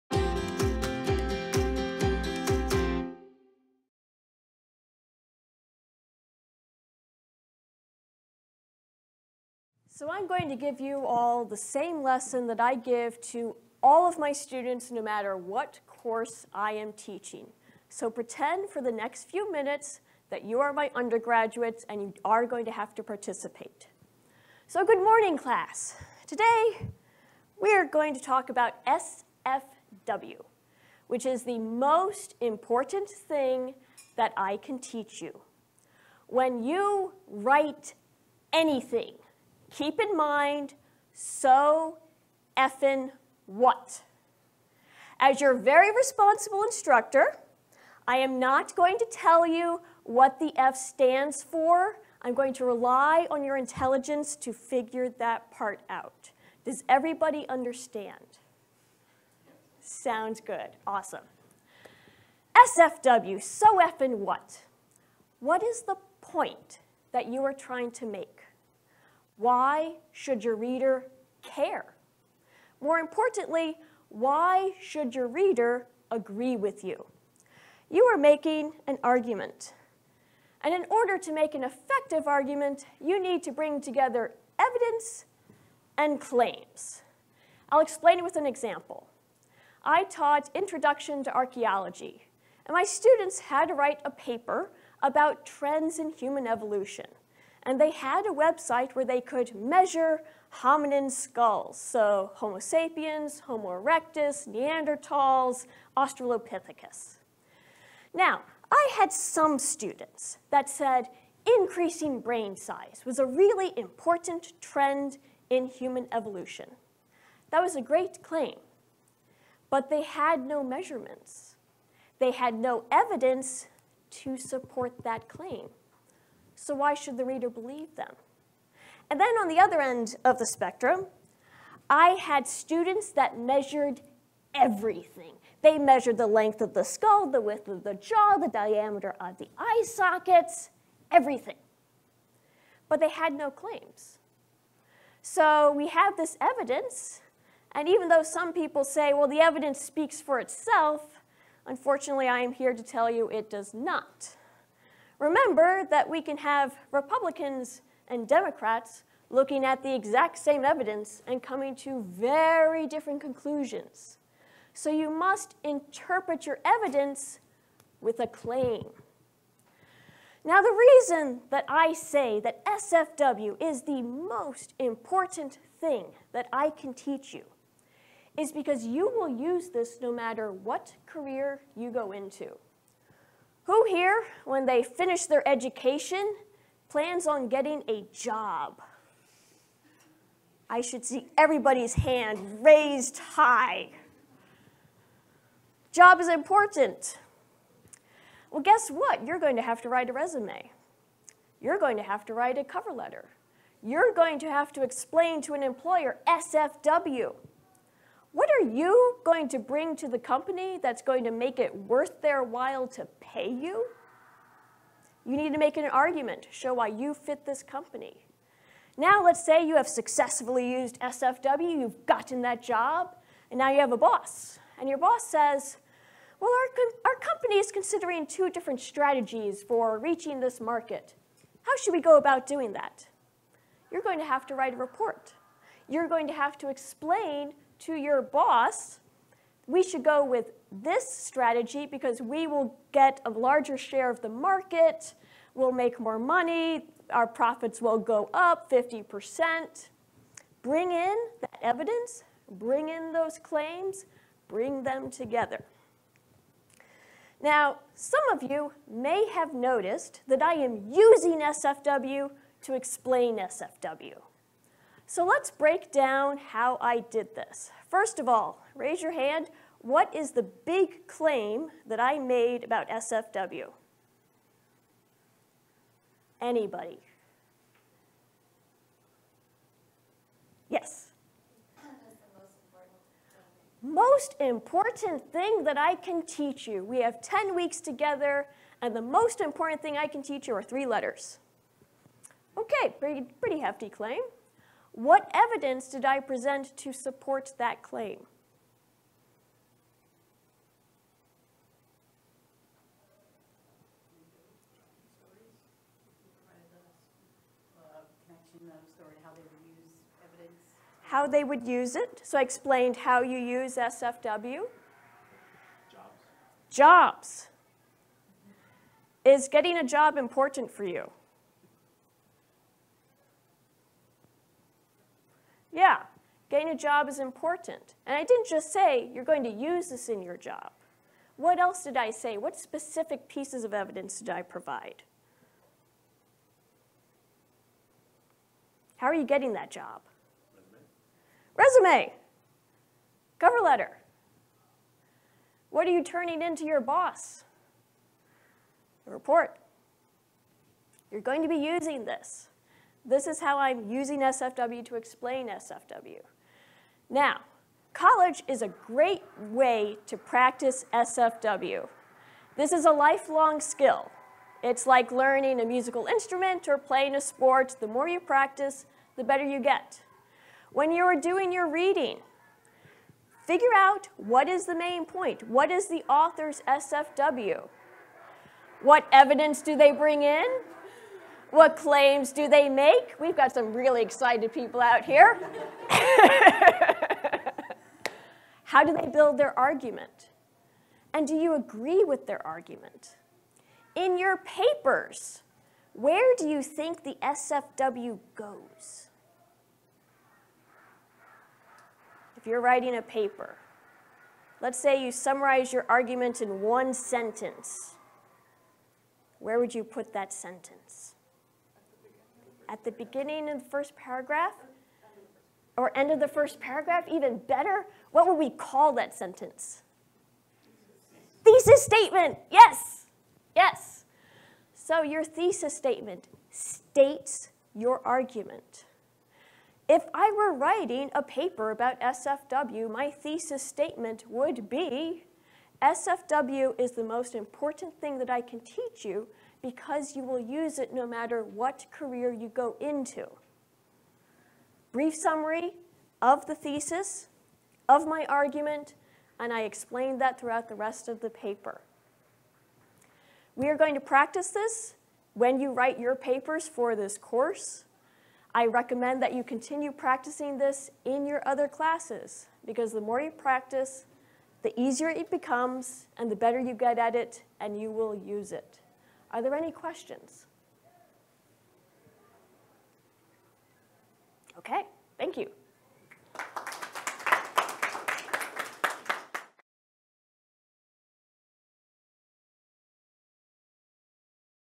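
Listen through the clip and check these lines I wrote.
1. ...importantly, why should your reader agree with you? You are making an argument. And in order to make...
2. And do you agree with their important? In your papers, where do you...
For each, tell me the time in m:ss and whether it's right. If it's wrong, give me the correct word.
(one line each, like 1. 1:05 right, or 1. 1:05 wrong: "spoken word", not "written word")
1. 1:12 right
2. 6:31 wrong: "argument", not "important".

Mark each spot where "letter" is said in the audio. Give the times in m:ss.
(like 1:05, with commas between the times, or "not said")
3:22, 4:50, 5:43.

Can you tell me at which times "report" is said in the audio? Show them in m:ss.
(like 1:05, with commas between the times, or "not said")
3:54, 5:49.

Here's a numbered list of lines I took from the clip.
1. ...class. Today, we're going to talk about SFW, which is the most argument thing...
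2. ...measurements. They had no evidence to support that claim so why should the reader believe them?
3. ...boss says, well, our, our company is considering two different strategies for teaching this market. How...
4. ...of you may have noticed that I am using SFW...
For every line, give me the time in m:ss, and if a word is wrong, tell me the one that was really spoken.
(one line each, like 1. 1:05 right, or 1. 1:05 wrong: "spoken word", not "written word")
1. 0:25 wrong: "important", not "argument"
2. 2:00 right
3. 3:44 wrong: "reaching", not "teaching"
4. 4:18 right.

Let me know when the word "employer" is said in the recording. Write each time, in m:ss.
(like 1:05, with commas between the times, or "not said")
3:25.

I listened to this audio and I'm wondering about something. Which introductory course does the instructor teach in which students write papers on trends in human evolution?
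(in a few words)
Introduction to Archaeology.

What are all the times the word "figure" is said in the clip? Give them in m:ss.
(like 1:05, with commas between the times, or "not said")
0:54, 6:13.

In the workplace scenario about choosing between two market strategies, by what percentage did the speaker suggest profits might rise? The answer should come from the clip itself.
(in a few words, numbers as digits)
50%.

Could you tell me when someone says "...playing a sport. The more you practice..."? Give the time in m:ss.
6:06.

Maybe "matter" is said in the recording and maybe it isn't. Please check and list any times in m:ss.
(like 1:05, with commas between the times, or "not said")
0:14, 3:00, 7:21.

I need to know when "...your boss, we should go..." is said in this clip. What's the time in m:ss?
3:57.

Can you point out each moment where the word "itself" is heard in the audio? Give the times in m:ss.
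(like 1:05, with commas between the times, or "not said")
2:30.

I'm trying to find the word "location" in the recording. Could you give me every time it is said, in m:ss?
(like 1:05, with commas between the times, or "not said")
not said.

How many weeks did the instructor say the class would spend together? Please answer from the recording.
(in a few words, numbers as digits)
10.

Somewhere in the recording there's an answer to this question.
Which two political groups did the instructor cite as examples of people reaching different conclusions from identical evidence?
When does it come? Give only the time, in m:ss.
2:36.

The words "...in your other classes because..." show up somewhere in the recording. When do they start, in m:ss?
7:41.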